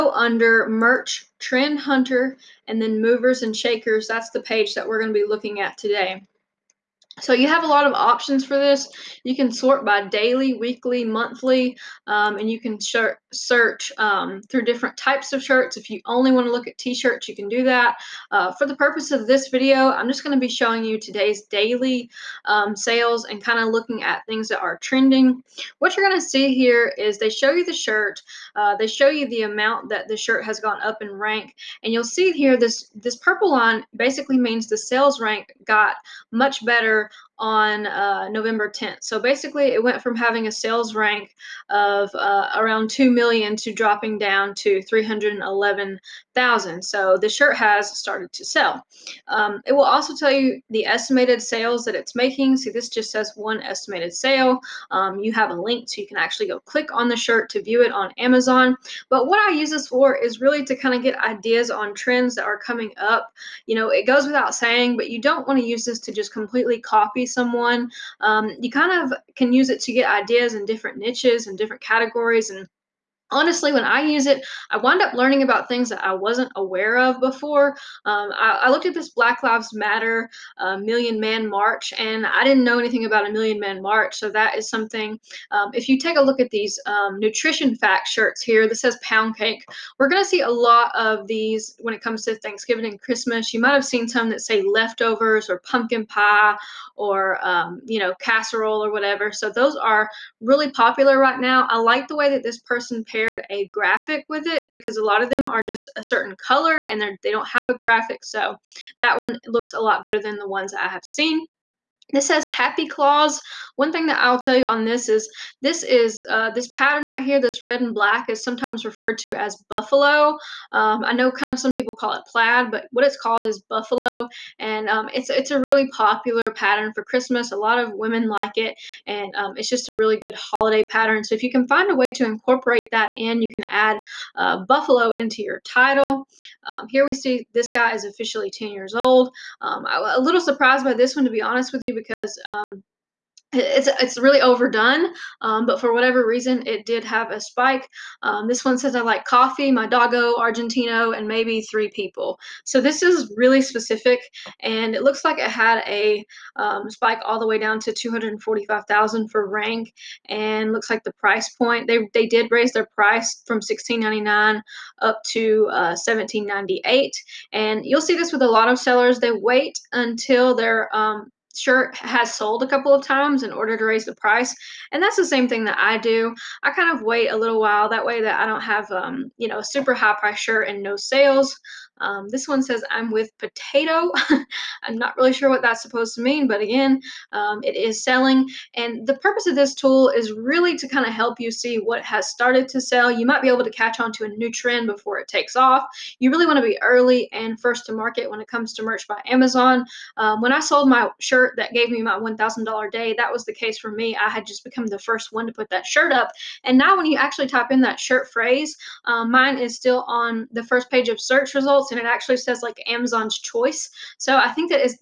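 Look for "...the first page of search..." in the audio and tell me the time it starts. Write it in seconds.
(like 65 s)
210 s.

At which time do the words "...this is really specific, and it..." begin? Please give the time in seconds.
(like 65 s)
152 s.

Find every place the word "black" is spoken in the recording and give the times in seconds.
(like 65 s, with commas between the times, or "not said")
79 s, 117 s.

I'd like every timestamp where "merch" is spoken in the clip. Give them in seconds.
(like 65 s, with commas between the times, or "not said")
0 s, 198 s.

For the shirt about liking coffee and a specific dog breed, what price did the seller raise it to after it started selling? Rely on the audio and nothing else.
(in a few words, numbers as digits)
$17.98.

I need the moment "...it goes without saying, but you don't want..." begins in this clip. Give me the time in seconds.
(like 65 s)
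63 s.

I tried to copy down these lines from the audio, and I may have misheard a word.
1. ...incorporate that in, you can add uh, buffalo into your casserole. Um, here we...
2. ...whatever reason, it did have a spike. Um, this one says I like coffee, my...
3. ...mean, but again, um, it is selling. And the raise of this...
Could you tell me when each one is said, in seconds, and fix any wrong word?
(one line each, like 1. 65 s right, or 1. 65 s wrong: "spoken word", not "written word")
1. 132 s wrong: "title", not "casserole"
2. 145 s right
3. 186 s wrong: "purpose", not "raise".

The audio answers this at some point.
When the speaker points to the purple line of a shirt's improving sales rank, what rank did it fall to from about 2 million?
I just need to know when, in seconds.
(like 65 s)
44 s.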